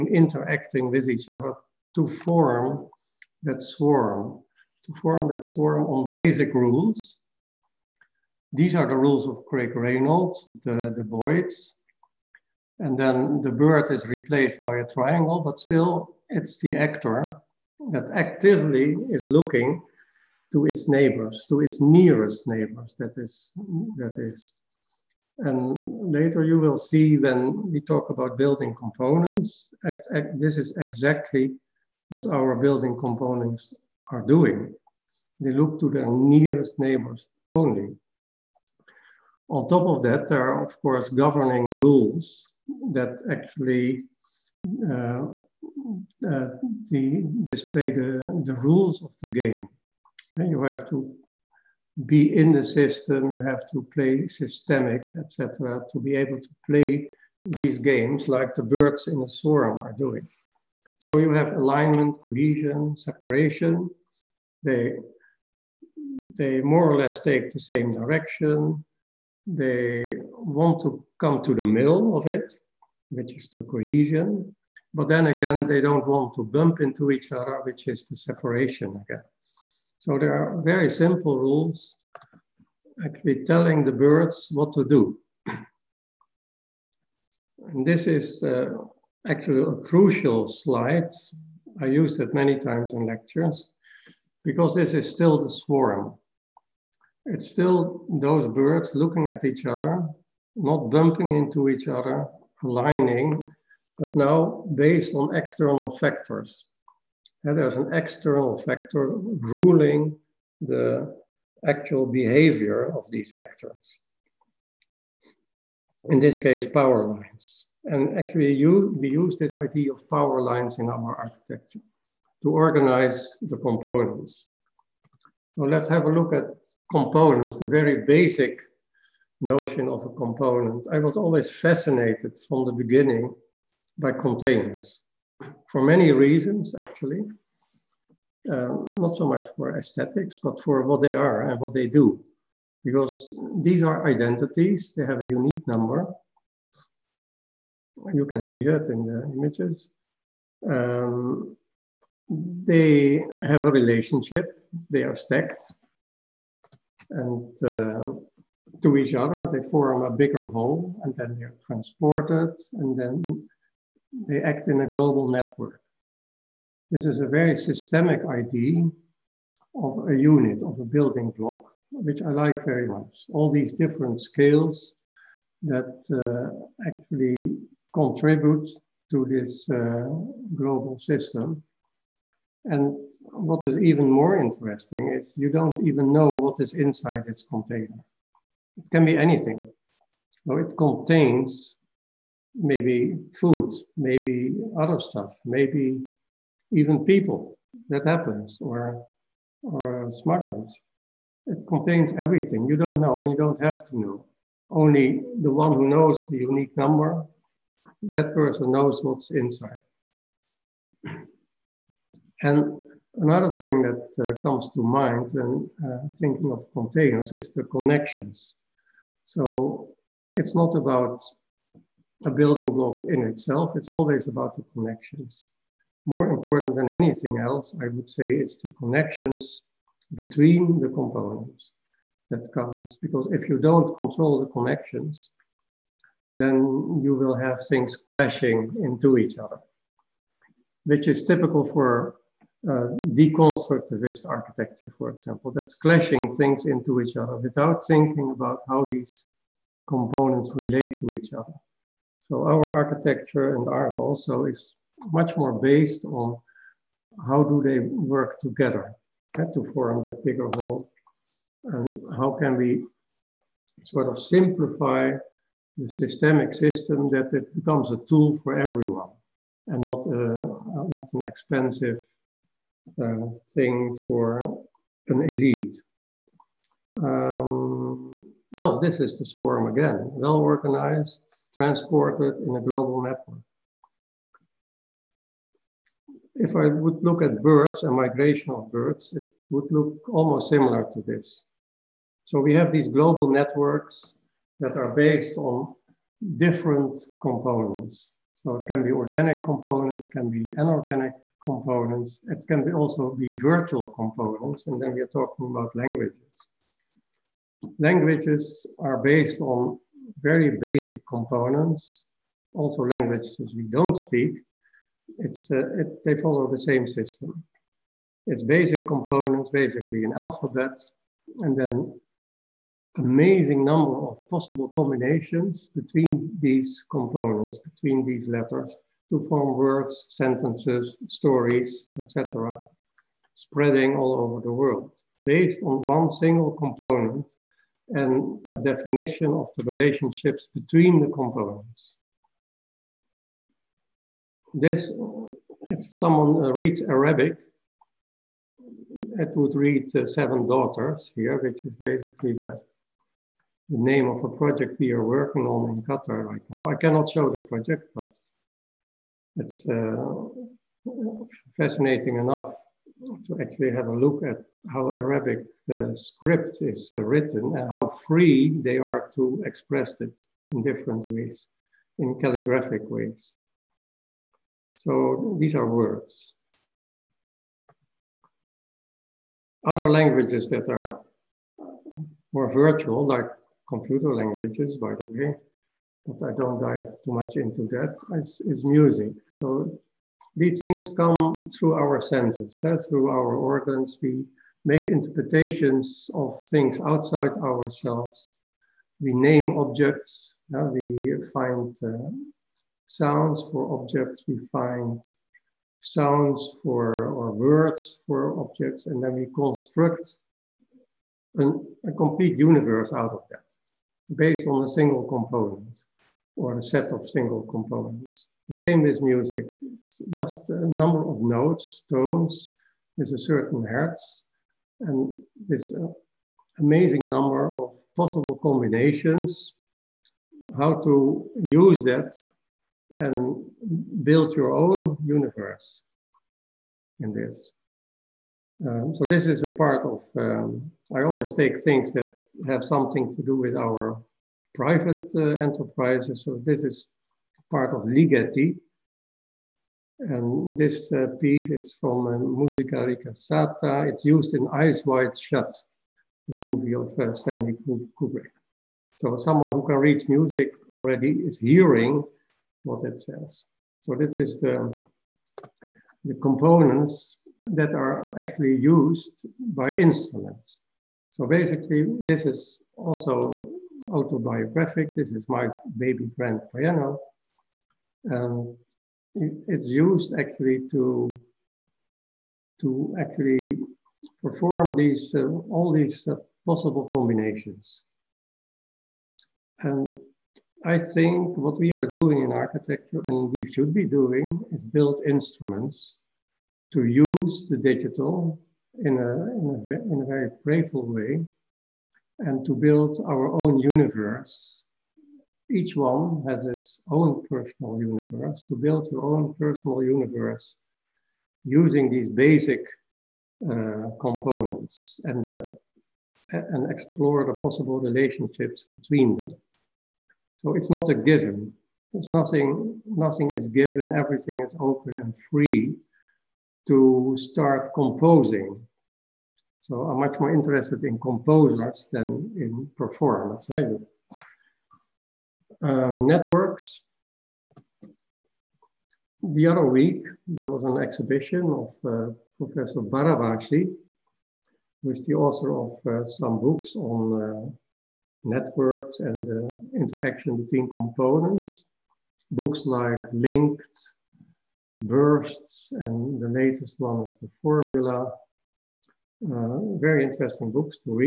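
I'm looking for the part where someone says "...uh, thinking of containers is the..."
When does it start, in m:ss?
3:35.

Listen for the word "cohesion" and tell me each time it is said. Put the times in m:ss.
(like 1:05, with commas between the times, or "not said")
1:02, 1:13.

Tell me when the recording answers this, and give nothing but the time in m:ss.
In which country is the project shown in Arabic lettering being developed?
5:55.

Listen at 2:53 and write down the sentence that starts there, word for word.
All these different scales that uh, actually contribute to this uh, global system.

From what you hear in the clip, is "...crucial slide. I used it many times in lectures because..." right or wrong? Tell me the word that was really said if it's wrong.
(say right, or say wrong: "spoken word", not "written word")
right.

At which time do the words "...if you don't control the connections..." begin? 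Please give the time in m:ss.
3:53.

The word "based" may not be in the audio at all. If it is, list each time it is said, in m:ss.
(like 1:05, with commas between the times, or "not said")
1:44, 4:15, 4:54, 5:09, 5:35, 6:54.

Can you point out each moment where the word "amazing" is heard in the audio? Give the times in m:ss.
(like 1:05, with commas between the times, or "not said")
5:22, 7:06.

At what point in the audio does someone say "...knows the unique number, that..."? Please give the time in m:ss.
3:25.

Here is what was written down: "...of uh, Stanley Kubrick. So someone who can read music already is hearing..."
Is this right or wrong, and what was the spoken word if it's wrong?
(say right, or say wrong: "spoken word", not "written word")
right.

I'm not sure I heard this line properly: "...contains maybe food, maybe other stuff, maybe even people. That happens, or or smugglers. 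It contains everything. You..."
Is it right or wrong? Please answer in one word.
right.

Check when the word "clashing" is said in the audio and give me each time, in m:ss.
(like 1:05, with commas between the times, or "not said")
3:57, 4:05.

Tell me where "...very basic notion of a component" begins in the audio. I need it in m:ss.
2:07.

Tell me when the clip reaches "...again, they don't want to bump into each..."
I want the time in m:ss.
1:15.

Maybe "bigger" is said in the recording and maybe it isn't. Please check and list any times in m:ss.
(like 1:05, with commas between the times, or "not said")
2:40, 4:20.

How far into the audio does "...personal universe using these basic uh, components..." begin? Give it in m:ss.
8:29.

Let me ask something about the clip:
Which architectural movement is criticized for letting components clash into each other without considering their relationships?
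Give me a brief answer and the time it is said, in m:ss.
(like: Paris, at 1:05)
Deconstructivist, at 4:03.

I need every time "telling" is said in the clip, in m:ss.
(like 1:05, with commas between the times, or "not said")
1:23.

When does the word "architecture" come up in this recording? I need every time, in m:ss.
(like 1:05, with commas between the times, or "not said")
2:01, 4:04, 4:12, 8:12.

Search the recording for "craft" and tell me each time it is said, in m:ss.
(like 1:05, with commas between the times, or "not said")
not said.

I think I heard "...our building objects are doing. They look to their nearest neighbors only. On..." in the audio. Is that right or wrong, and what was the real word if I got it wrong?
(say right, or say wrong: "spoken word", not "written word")
wrong: "components", not "objects".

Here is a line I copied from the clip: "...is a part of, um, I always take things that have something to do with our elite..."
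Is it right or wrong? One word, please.
wrong.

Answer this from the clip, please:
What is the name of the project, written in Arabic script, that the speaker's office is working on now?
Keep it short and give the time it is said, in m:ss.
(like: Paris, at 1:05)
Seven Daughters, at 5:50.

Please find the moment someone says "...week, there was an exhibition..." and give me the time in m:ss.
8:59.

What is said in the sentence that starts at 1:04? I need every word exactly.
They, they more or less take the same direction.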